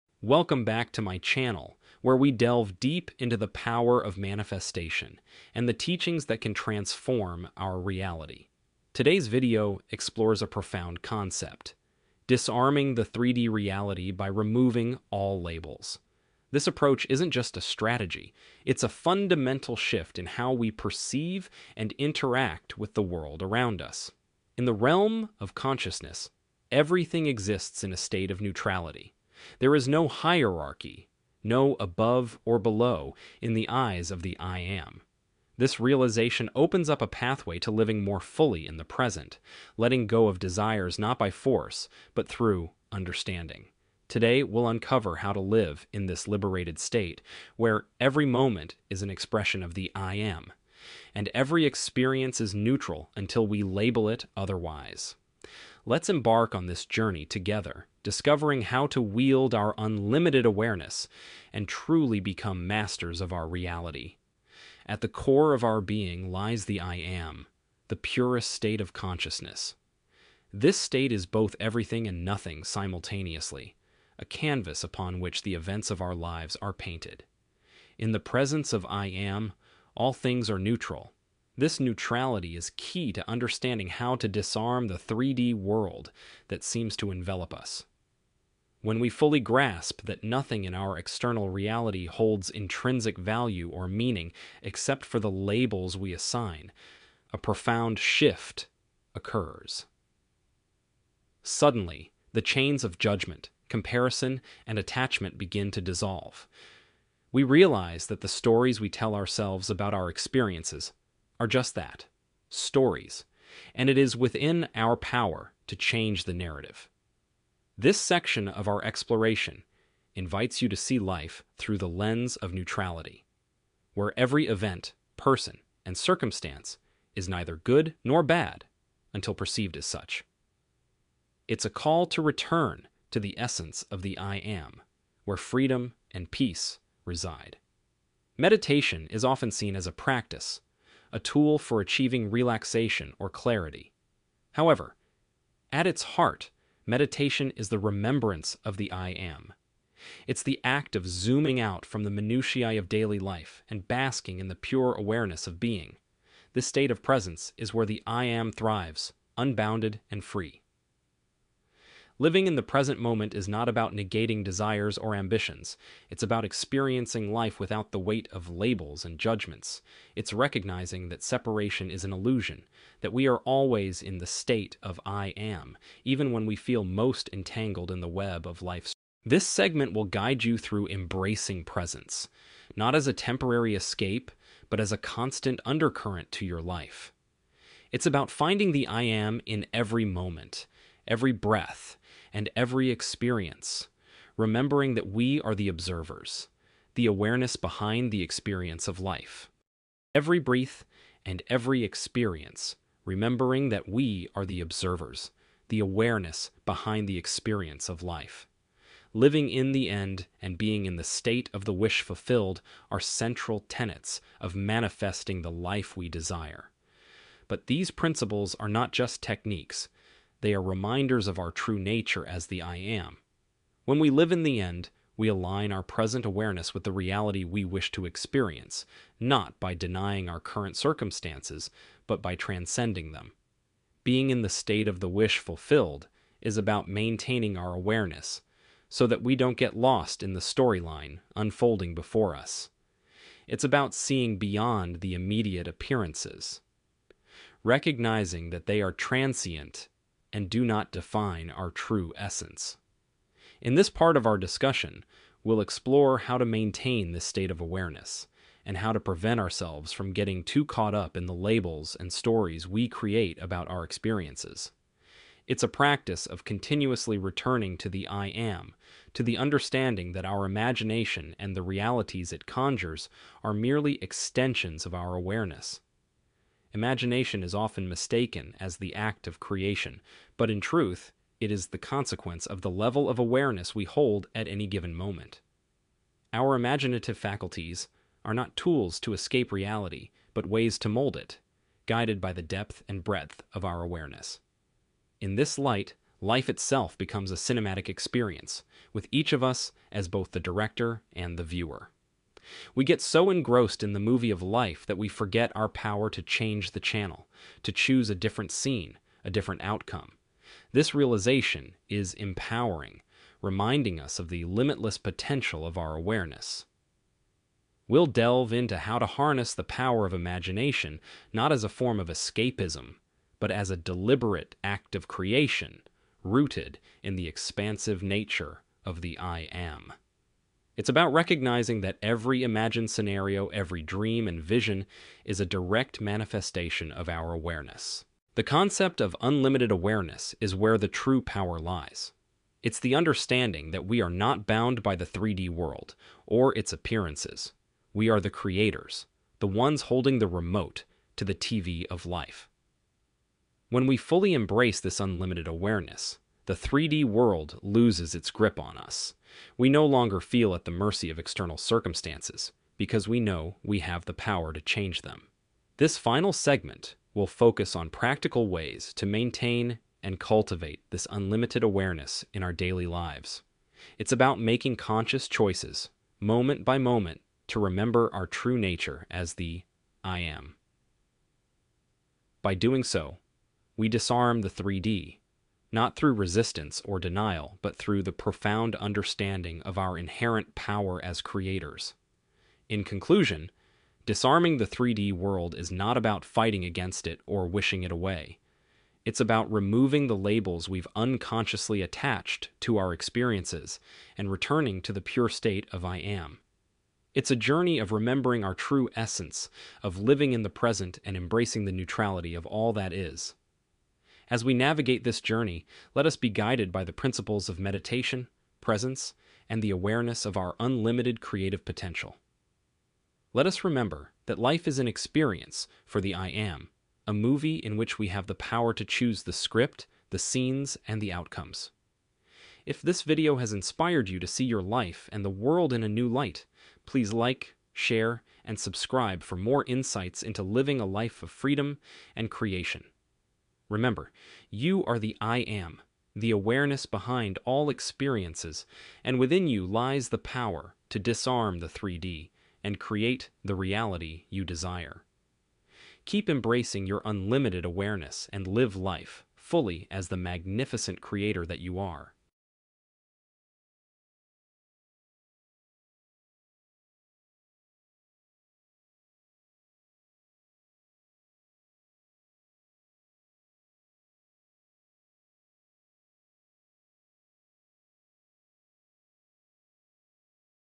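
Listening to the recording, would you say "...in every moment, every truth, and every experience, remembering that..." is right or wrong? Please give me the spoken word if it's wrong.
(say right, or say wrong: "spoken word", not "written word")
wrong: "breath", not "truth".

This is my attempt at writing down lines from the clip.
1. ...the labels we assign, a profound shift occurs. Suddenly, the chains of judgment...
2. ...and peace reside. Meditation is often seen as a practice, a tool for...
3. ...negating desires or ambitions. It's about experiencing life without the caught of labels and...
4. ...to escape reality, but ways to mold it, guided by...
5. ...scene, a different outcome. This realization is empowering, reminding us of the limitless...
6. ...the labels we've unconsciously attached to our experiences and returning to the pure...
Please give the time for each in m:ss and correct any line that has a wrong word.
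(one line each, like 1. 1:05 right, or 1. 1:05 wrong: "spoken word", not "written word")
1. 1:35 right
2. 2:16 right
3. 2:43 wrong: "weight", not "caught"
4. 4:49 right
5. 5:08 right
6. 6:40 right.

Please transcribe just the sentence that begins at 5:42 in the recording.
It's the understanding that we are not bound by the 3D world or its appearances.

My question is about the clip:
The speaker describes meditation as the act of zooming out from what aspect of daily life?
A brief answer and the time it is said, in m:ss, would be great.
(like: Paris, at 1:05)
The minutiae, at 2:32.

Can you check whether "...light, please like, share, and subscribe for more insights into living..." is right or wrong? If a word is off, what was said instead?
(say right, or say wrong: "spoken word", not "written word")
right.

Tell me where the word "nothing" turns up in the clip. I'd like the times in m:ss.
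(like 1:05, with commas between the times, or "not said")
1:12, 1:30.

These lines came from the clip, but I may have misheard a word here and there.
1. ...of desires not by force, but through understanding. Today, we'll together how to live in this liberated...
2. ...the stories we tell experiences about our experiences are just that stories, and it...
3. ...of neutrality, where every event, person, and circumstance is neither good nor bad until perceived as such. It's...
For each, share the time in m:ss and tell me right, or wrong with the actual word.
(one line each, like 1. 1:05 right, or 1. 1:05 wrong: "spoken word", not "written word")
1. 0:40 wrong: "uncover", not "together"
2. 1:48 wrong: "ourselves", not "experiences"
3. 2:02 right.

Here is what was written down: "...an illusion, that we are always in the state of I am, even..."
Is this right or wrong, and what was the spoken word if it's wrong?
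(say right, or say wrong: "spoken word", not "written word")
right.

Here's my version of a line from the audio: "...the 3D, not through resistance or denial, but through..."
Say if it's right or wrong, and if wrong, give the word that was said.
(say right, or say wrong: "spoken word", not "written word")
right.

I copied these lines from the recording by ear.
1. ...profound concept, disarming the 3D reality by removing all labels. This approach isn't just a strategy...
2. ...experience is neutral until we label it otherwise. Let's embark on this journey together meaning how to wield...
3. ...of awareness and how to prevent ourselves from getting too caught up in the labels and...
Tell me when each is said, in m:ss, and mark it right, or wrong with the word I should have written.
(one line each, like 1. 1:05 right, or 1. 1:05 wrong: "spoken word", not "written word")
1. 0:10 right
2. 0:51 wrong: "discovering", not "meaning"
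3. 4:17 right.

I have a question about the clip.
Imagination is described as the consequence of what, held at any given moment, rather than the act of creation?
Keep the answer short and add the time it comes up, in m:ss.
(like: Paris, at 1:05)
The level of awareness, at 4:42.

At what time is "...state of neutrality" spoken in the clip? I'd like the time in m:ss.
0:27.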